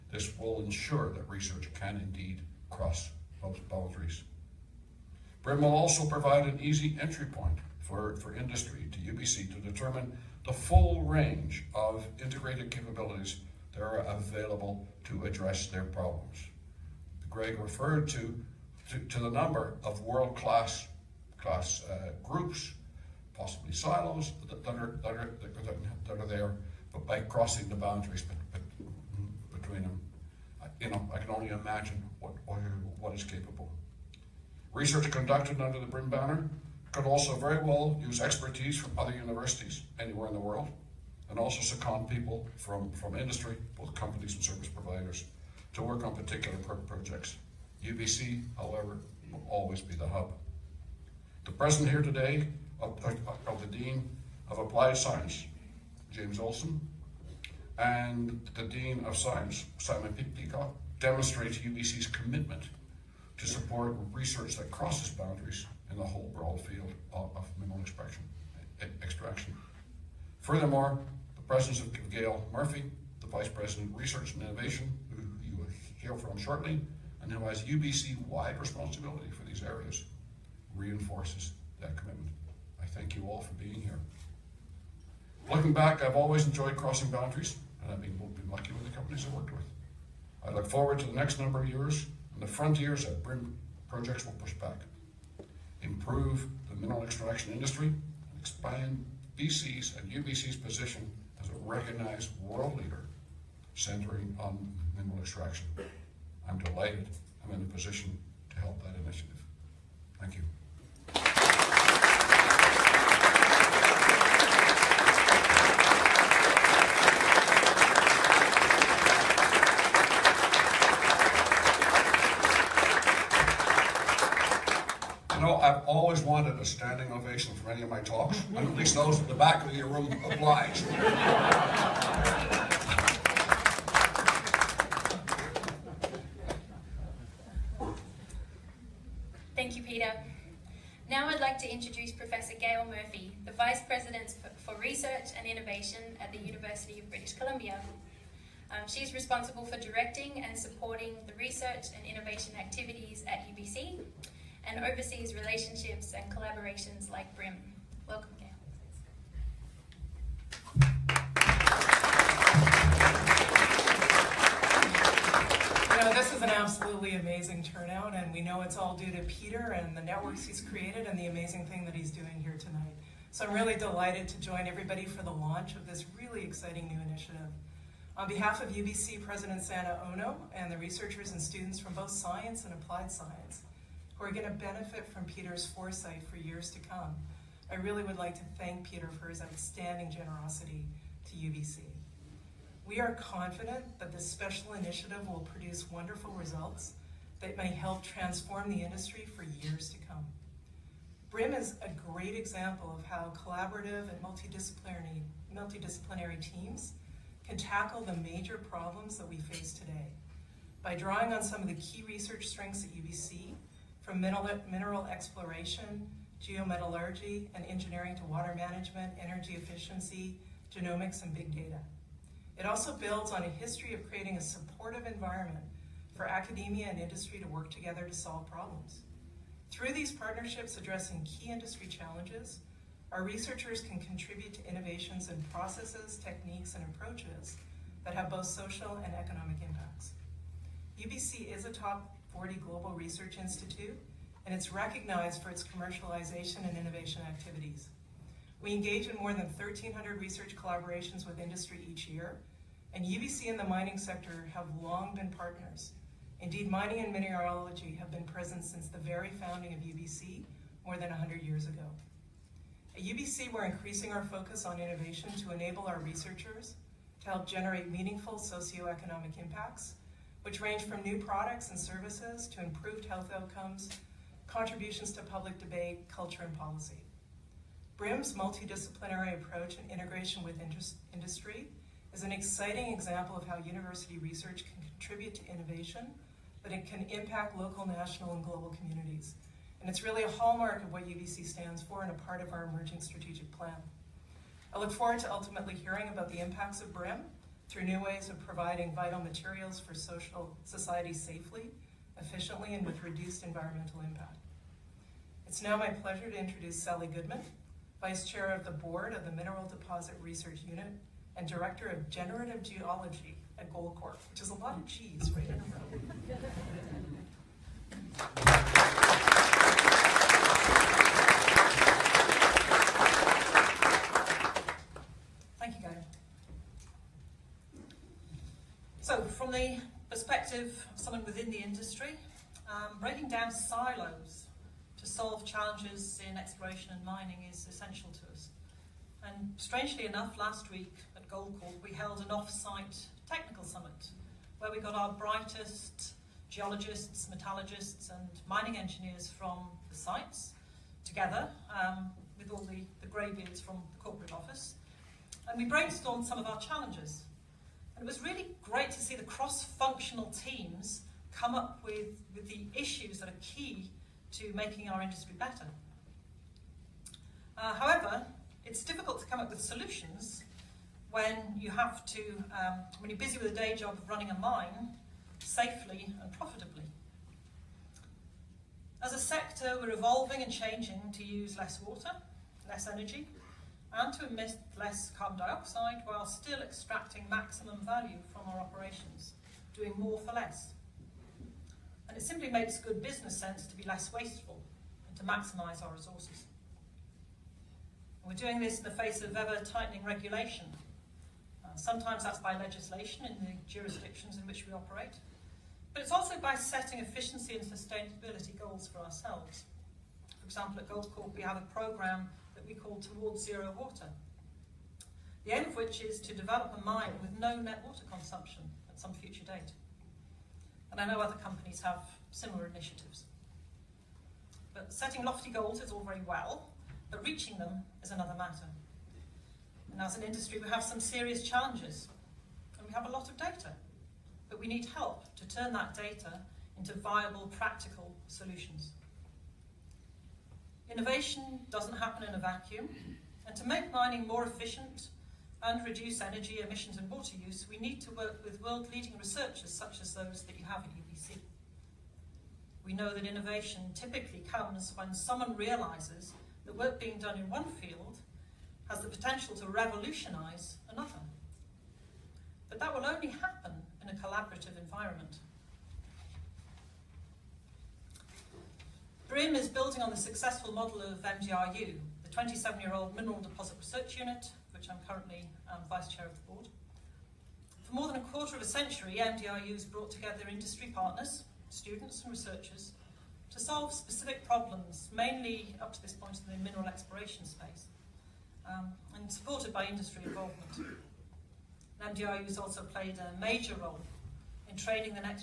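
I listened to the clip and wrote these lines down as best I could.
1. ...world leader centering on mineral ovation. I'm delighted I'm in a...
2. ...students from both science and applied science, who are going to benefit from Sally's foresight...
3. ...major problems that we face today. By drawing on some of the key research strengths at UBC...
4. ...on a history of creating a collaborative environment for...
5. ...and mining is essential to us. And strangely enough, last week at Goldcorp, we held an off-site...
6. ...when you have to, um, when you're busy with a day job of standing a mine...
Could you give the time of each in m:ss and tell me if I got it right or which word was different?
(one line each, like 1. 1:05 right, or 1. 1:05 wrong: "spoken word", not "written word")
1. 1:42 wrong: "extraction", not "ovation"
2. 3:01 wrong: "Peter", not "Sally"
3. 3:28 right
4. 3:43 wrong: "supportive", not "collaborative"
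5. 5:36 right
6. 6:11 wrong: "running", not "standing".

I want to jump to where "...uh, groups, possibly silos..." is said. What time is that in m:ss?
0:21.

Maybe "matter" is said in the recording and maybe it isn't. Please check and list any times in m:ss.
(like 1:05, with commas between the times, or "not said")
7:08.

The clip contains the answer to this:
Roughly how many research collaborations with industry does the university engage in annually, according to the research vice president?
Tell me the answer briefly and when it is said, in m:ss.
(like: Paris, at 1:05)
1,300, at 4:09.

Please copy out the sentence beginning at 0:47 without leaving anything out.
UBC, however, will always be the hub.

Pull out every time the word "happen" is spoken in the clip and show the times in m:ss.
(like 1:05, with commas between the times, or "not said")
7:21, 7:43.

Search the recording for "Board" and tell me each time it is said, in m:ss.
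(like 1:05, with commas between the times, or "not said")
5:08, 7:56.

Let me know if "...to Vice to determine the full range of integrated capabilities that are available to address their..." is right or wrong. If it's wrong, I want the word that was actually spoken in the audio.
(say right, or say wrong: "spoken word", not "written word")
wrong: "UBC", not "Vice".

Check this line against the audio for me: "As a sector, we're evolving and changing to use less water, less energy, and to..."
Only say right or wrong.
right.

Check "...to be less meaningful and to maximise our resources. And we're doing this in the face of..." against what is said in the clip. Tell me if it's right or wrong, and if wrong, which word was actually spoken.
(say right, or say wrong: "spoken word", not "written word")
wrong: "wasteful", not "meaningful".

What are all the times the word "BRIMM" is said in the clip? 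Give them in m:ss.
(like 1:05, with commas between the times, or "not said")
0:05, 0:35, 1:33, 2:37, 3:21, 4:37, 4:56, 7:49.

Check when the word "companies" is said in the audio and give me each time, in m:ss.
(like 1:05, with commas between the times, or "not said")
0:43, 1:28, 7:01.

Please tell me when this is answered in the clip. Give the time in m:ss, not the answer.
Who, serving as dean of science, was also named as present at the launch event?
0:59.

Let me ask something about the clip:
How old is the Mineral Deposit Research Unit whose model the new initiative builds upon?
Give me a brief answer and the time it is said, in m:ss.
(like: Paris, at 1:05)
27 years, at 7:52.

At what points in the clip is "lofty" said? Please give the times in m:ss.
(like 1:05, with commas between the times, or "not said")
7:05.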